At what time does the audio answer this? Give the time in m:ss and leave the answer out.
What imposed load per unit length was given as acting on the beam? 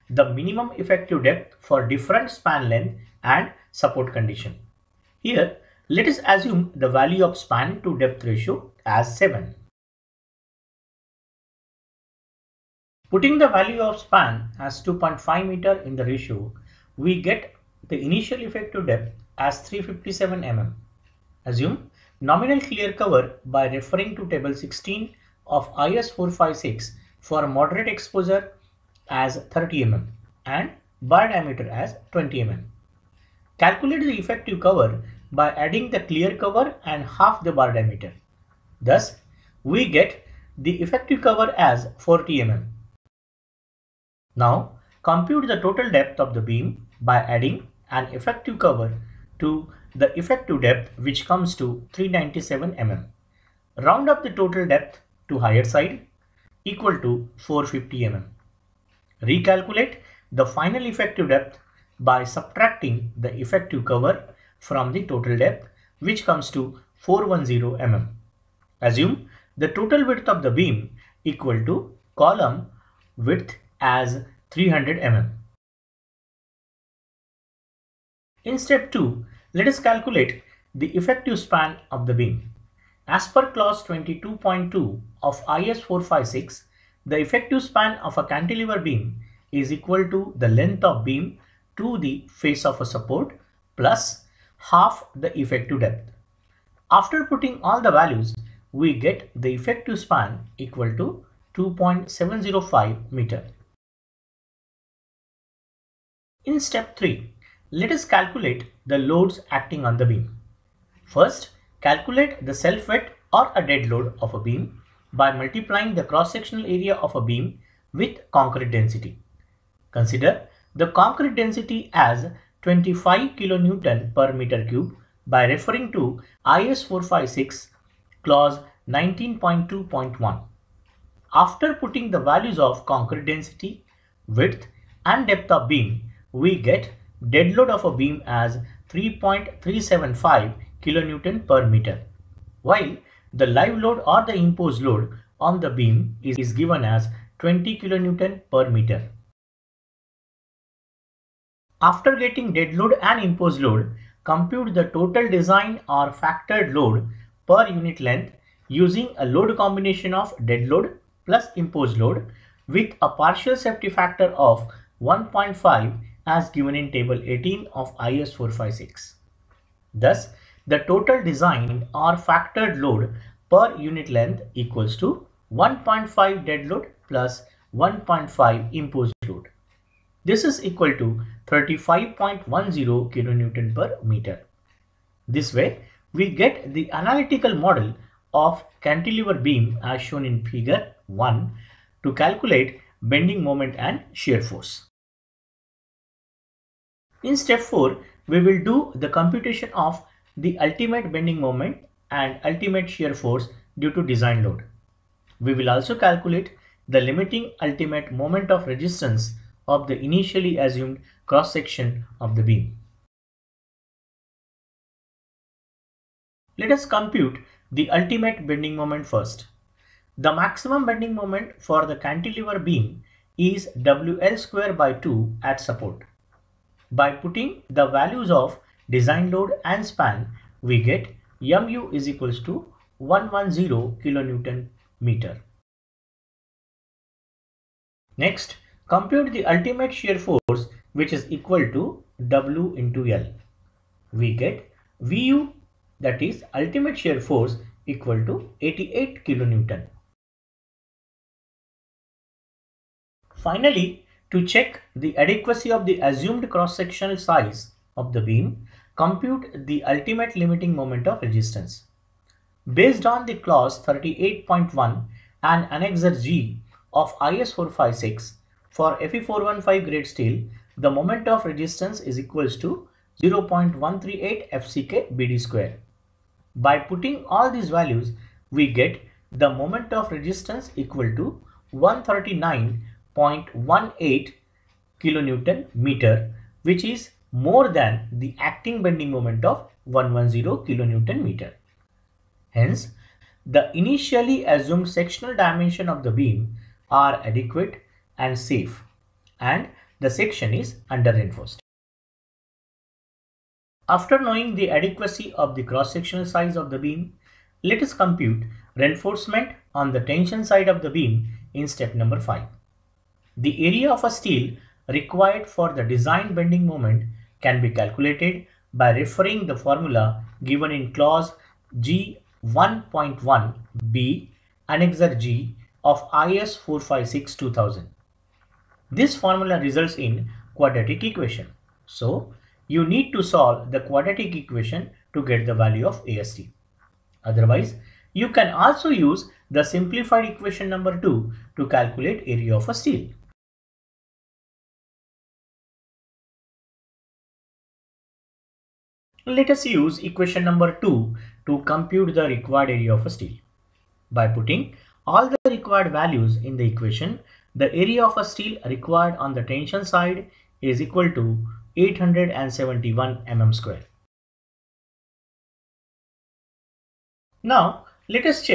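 2:27.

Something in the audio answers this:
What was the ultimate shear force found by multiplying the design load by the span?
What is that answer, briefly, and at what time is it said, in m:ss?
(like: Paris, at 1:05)
88 kilonewton, at 4:08.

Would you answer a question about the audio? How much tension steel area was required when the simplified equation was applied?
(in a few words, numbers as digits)
871 mm square.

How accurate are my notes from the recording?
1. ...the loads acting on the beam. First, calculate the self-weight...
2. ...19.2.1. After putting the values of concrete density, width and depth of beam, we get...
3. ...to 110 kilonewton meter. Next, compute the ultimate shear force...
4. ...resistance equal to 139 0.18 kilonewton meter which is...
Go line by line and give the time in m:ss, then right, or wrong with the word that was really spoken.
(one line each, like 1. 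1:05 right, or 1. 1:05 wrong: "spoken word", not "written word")
1. 1:48 right
2. 2:08 right
3. 3:52 right
4. 4:40 right.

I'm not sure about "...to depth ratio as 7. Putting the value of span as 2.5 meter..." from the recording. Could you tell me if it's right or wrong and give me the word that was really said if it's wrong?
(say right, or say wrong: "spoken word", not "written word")
right.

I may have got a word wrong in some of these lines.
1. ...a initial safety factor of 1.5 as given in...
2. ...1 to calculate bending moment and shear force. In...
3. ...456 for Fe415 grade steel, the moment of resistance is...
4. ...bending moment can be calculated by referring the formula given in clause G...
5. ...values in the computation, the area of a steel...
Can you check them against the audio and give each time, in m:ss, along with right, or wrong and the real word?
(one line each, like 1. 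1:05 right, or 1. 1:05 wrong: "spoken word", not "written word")
1. 2:43 wrong: "partial", not "initial"
2. 3:11 right
3. 4:27 right
4. 5:16 right
5. 5:55 wrong: "equation", not "computation".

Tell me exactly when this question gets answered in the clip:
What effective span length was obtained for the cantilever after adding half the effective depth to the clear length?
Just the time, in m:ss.
1:41.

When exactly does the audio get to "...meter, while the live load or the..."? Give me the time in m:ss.
2:21.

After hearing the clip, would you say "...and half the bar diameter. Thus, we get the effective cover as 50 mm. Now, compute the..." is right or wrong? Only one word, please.
wrong.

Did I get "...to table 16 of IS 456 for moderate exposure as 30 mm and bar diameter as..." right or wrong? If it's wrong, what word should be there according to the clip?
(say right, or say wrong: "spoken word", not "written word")
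right.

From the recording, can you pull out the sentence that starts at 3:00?
This is equal to 35.10 kilonewton per meter.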